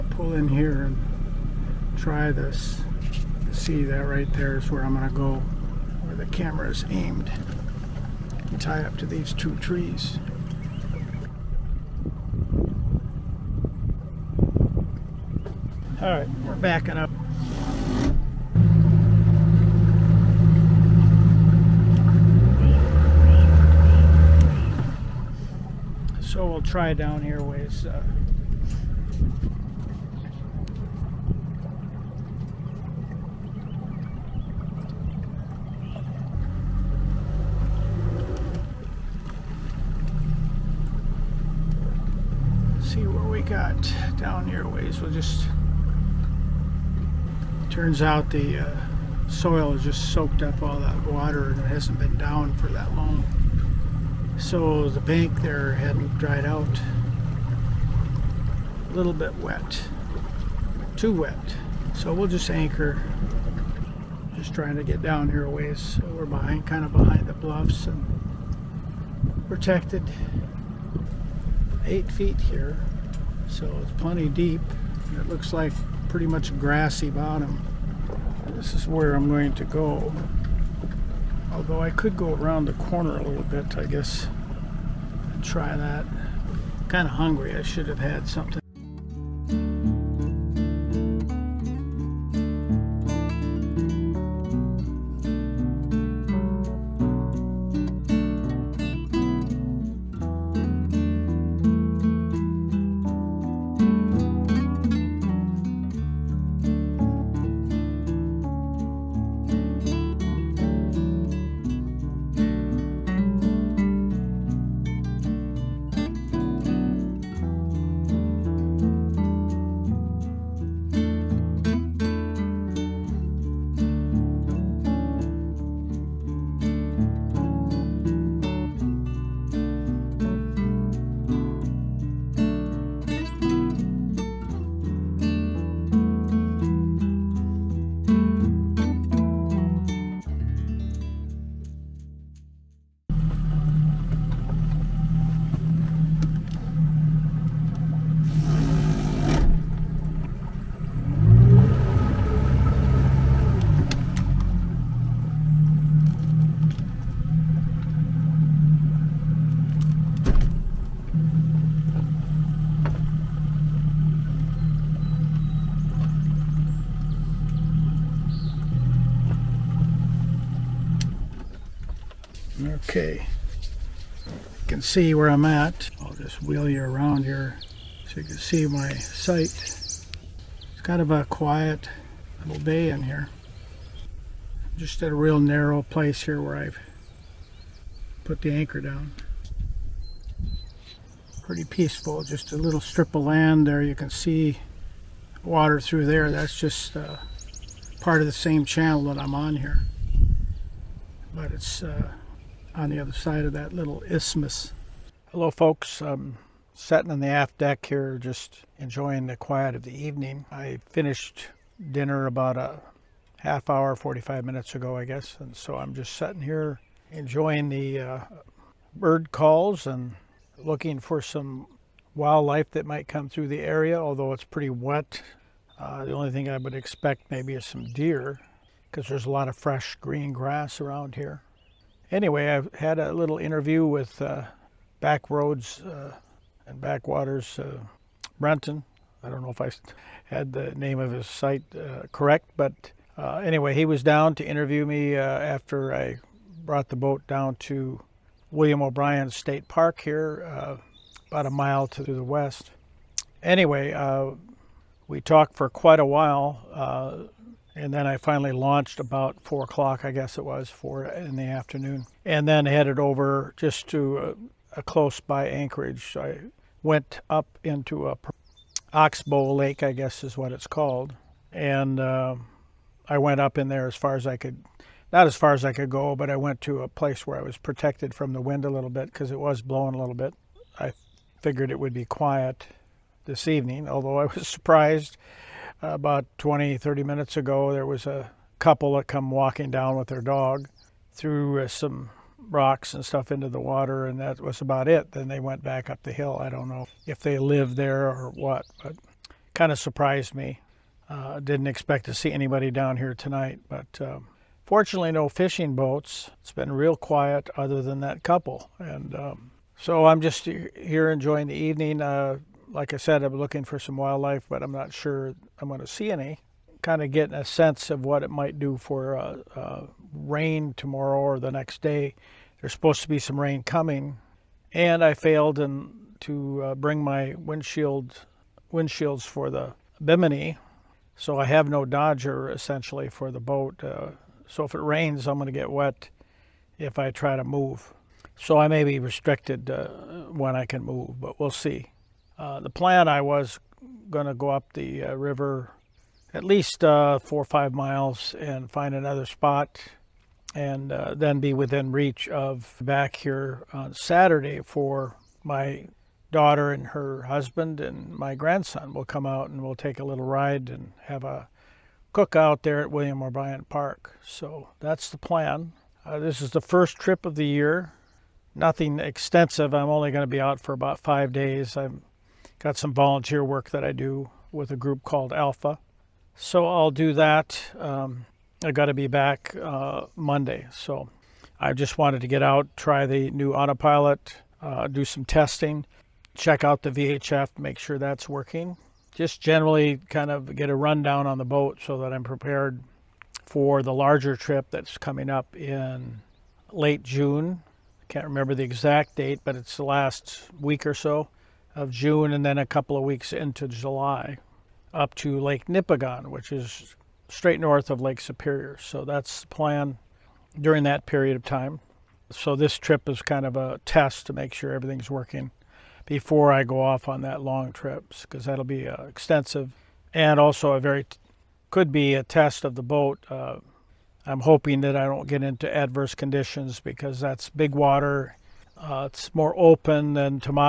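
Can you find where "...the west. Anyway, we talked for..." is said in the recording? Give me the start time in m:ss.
4:12.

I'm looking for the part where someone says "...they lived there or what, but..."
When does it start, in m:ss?
4:57.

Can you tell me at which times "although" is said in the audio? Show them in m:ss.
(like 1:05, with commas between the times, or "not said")
1:21, 3:43, 4:43.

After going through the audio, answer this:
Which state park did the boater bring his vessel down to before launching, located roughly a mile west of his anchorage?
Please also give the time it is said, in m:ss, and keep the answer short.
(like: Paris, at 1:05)
William O'Brien State Park, at 4:08.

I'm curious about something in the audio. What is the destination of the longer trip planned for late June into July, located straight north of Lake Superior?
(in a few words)
Lake Nipigon.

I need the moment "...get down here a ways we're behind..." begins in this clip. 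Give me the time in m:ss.
1:04.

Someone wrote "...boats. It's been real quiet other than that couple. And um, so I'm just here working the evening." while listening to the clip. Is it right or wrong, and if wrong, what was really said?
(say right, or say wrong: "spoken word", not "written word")
wrong: "enjoying", not "working".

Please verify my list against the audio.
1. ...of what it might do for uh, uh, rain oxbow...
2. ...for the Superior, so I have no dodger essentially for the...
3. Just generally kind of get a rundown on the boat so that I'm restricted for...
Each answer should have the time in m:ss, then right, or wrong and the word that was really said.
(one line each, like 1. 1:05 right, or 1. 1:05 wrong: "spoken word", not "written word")
1. 5:17 wrong: "tomorrow", not "oxbow"
2. 5:29 wrong: "Bimini", not "Superior"
3. 6:29 wrong: "prepared", not "restricted".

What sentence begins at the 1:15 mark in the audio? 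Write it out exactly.
It looks like pretty much grassy bottom.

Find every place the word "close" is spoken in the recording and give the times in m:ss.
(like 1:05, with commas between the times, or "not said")
4:24.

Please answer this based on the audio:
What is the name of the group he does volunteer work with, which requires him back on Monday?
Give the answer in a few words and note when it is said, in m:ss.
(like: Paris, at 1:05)
Alpha, at 6:15.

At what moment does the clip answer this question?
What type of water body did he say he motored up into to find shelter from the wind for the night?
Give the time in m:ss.
4:28.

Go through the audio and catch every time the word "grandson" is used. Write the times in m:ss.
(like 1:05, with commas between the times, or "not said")
5:58.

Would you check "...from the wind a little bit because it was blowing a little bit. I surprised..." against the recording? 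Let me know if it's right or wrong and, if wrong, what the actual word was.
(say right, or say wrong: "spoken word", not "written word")
wrong: "figured", not "surprised".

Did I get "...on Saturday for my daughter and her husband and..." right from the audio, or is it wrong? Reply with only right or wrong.
right.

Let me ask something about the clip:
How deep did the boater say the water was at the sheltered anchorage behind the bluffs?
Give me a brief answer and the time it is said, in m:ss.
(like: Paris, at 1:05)
8 feet, at 1:11.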